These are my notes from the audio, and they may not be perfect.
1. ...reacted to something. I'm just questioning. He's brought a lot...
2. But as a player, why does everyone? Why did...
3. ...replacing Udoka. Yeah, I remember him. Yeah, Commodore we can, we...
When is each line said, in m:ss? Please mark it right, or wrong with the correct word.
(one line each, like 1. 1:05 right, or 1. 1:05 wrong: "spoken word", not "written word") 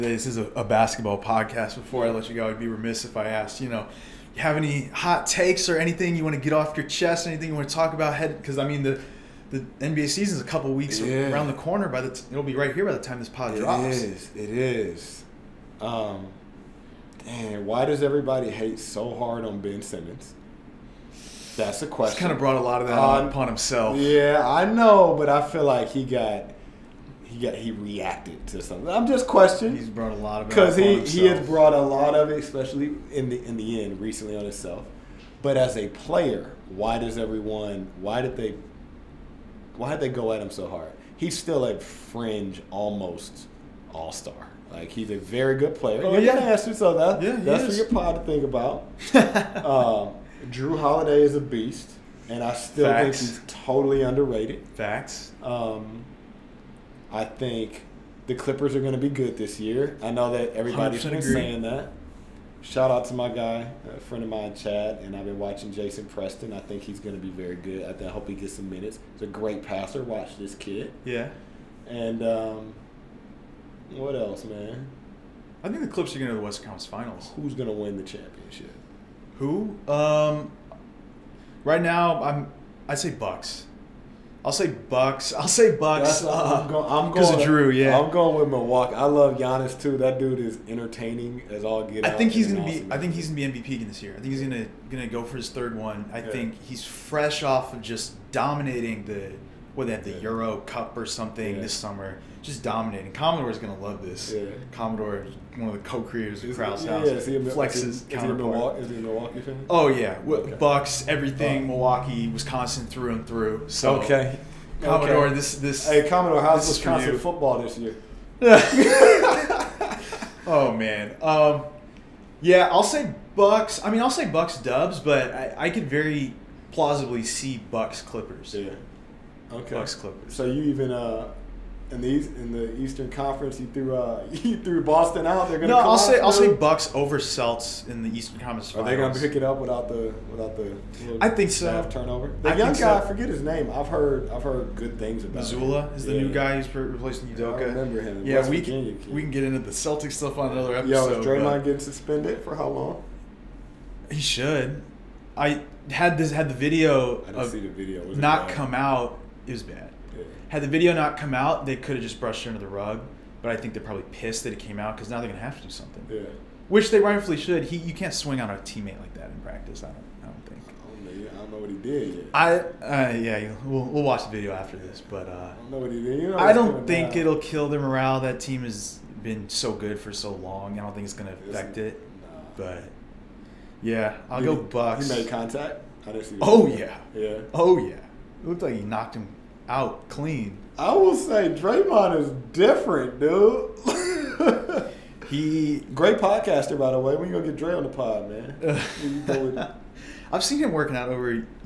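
1. 0:27 right
2. 0:35 right
3. 2:26 wrong: "West", not "Commodore".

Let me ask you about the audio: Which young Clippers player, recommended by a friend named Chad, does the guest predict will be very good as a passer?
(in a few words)
Jason Preston.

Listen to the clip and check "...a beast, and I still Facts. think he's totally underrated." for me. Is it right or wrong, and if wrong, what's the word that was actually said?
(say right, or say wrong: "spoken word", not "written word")
right.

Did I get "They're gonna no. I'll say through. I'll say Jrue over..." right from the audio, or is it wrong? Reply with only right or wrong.
wrong.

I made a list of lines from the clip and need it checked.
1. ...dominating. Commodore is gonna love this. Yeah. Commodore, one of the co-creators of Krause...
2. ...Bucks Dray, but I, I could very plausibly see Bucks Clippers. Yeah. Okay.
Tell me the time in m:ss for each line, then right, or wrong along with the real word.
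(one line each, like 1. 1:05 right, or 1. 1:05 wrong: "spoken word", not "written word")
1. 1:42 right
2. 2:04 wrong: "Dubs", not "Dray".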